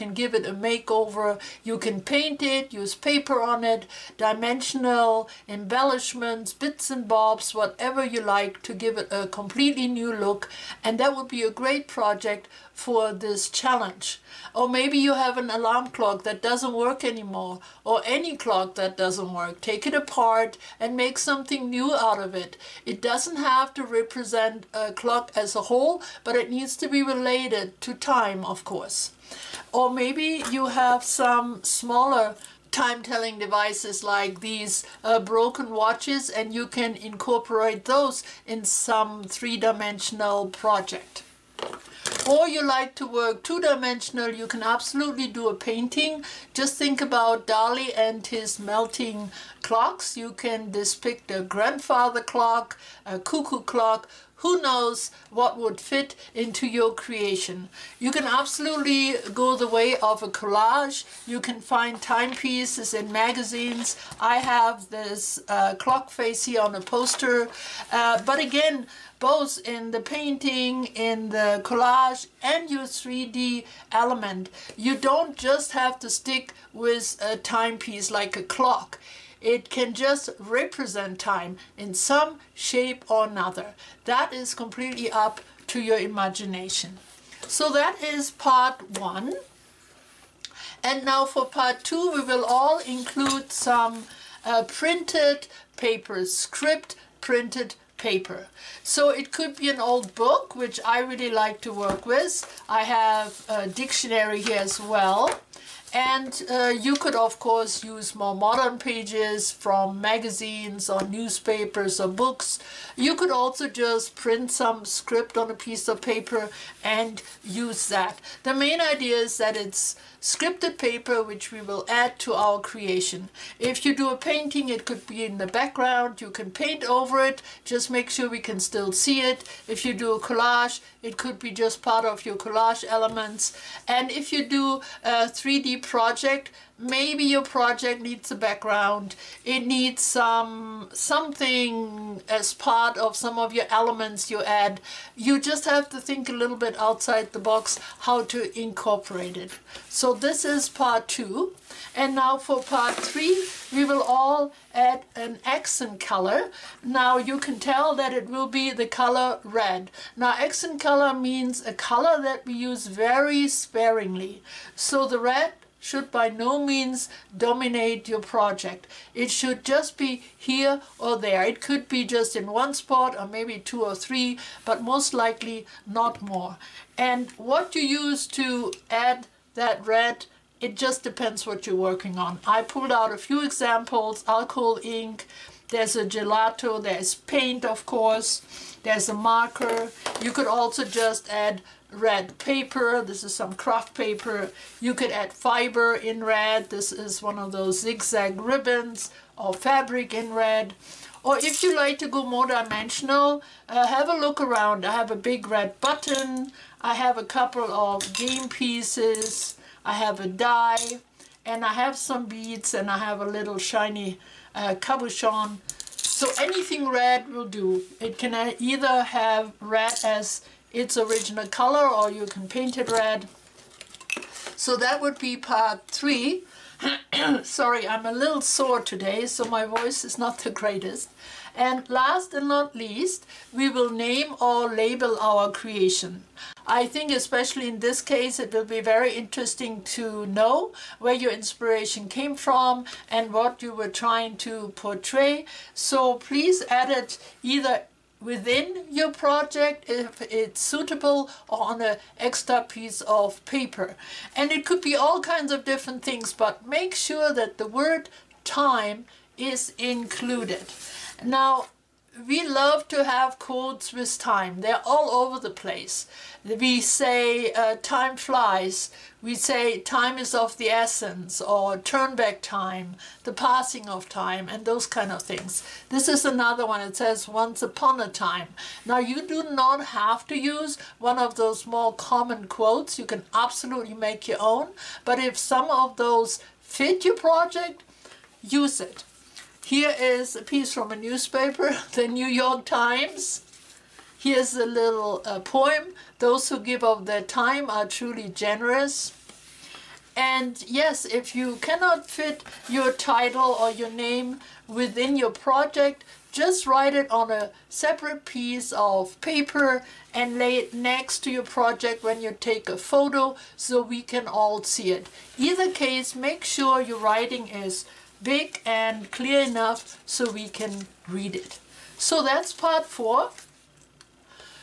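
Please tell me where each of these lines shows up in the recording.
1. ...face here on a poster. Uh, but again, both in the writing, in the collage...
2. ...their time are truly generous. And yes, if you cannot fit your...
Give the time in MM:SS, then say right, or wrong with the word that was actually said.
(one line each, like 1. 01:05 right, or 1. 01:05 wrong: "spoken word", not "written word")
1. 01:06 wrong: "painting", not "writing"
2. 04:57 right.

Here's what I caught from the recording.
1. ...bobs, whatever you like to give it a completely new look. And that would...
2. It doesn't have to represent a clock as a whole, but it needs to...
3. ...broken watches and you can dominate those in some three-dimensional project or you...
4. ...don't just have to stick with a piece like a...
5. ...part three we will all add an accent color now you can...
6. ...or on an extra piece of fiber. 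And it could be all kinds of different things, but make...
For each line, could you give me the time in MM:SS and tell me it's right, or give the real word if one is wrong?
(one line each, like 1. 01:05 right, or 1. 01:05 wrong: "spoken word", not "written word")
1. 00:07 right
2. 00:22 right
3. 00:35 wrong: "incorporate", not "dominate"
4. 01:14 wrong: "timepiece", not "piece"
5. 02:32 right
6. 04:11 wrong: "paper", not "fiber".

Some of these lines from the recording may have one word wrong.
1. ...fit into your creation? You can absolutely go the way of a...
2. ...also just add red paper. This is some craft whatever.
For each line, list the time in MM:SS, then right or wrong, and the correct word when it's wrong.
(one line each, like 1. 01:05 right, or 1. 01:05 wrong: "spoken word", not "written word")
1. 00:55 right
2. 03:10 wrong: "paper", not "whatever".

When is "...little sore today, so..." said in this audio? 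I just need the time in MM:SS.
03:48.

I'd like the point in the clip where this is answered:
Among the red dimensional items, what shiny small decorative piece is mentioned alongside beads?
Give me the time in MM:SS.
03:34.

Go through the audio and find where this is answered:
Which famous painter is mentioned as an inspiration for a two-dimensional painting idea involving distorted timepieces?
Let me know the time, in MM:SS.
00:47.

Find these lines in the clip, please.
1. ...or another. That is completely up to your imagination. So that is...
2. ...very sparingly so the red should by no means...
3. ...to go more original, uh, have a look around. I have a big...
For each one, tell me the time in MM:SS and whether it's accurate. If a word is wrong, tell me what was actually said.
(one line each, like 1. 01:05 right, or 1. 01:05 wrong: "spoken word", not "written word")
1. 01:23 right
2. 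02:42 right
3. 03:21 wrong: "dimensional", not "original".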